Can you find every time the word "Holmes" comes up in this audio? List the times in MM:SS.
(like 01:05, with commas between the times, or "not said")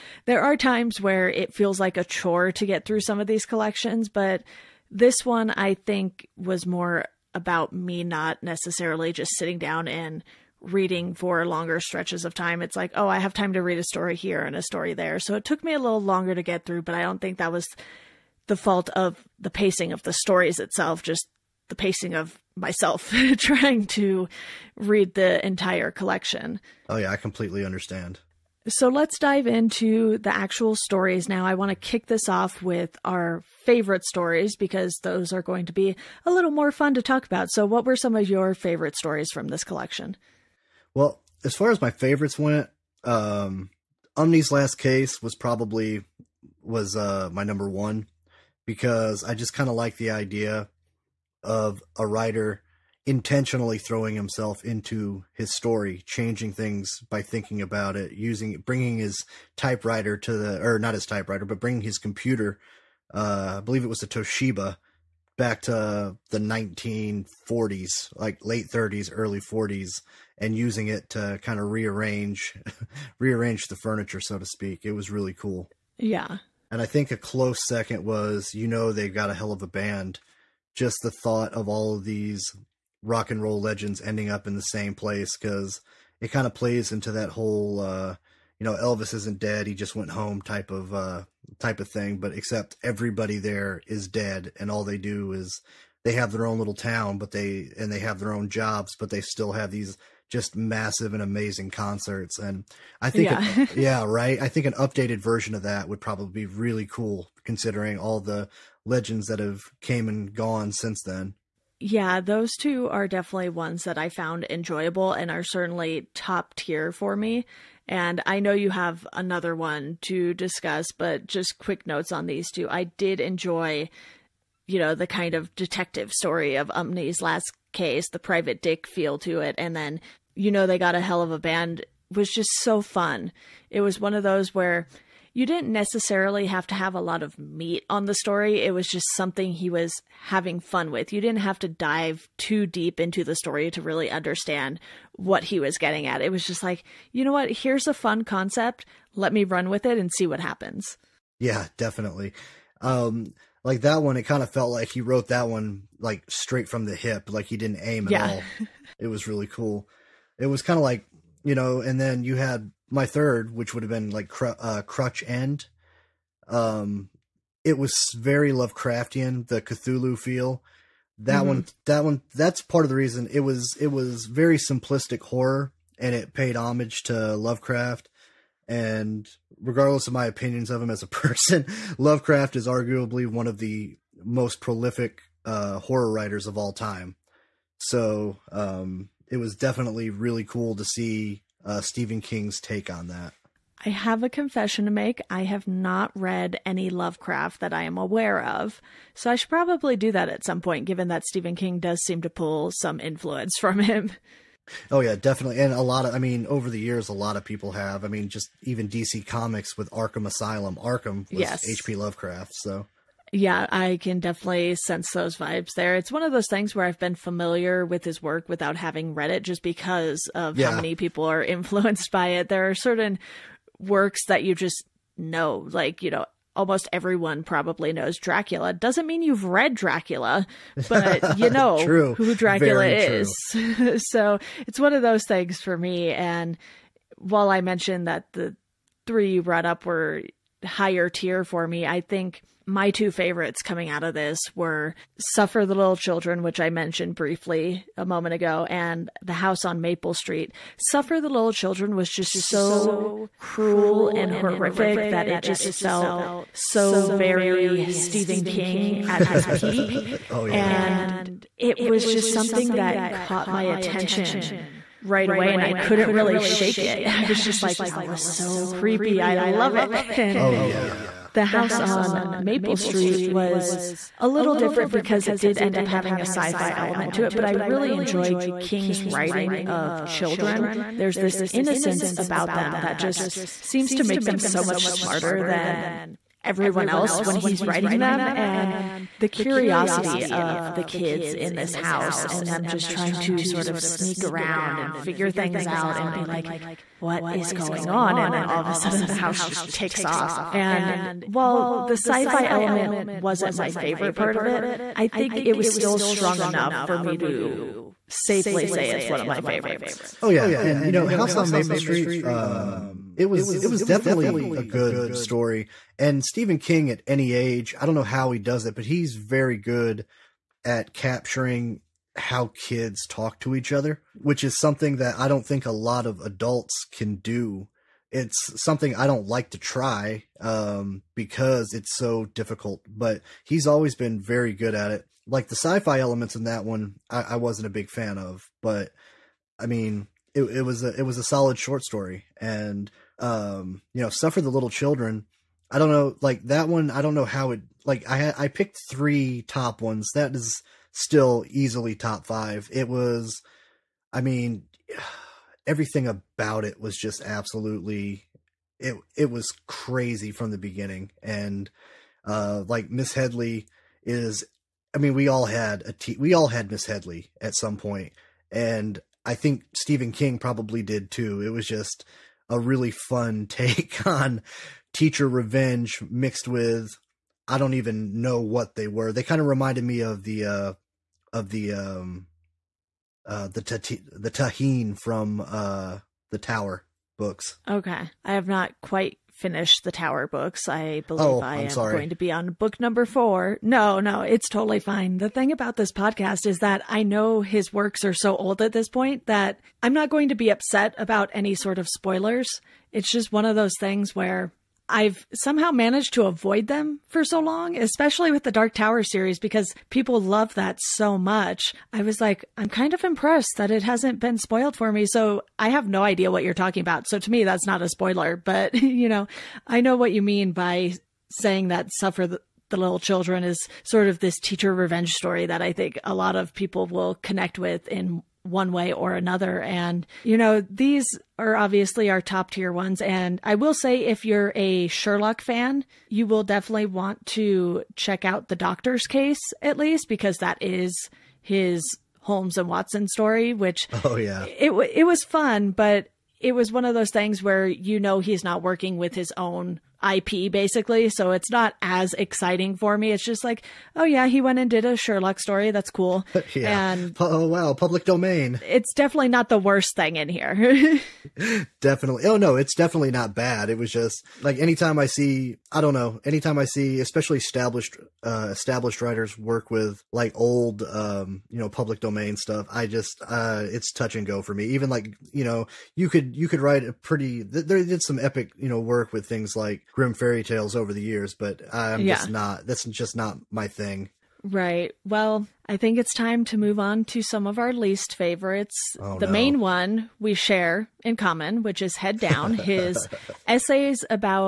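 07:22.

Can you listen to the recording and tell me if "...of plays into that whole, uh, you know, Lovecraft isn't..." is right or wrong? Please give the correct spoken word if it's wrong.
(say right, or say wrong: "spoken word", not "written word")
wrong: "Elvis", not "Lovecraft".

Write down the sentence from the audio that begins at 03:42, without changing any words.
There are certain works that you just know, like, you know, almost everyone probably knows Dracula.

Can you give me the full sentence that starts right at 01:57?
And I know you have another one to discuss, but just quick notes on these two.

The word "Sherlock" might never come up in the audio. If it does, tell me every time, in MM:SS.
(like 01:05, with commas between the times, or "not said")
07:14, 07:34.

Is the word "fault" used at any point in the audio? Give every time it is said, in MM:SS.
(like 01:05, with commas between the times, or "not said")
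00:18.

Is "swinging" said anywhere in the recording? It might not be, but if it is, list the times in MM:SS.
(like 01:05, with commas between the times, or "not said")
not said.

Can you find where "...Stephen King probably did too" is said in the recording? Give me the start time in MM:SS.
06:09.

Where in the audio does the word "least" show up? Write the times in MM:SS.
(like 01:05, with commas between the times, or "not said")
07:19, 08:07.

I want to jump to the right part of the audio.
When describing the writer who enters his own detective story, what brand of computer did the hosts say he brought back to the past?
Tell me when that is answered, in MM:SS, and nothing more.
01:04.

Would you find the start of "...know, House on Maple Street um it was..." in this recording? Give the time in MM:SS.
05:10.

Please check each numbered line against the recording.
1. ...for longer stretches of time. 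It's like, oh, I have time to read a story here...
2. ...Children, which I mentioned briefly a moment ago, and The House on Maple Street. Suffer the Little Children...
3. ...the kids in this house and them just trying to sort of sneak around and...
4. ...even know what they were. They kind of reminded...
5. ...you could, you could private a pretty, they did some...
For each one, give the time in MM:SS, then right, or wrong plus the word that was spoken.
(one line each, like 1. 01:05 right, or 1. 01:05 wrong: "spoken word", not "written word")
1. 00:11 right
2. 04:05 right
3. 04:50 right
4. 06:17 right
5. 07:55 wrong: "write", not "private".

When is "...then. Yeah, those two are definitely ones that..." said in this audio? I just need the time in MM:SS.
01:51.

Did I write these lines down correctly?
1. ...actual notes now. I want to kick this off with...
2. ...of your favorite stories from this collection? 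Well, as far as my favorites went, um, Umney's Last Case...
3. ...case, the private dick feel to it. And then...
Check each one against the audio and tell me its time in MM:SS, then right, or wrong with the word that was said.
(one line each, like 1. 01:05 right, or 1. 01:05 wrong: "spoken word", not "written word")
1. 00:30 wrong: "stories", not "notes"
2. 00:38 right
3. 02:07 right.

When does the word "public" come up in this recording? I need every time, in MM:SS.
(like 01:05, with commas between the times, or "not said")
07:37, 07:51.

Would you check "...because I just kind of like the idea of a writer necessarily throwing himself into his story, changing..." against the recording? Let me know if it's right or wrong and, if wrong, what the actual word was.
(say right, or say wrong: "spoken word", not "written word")
wrong: "intentionally", not "necessarily".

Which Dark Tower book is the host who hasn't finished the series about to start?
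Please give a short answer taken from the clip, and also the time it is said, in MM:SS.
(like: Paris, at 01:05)
4, at 06:33.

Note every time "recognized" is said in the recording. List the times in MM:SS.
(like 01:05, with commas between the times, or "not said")
not said.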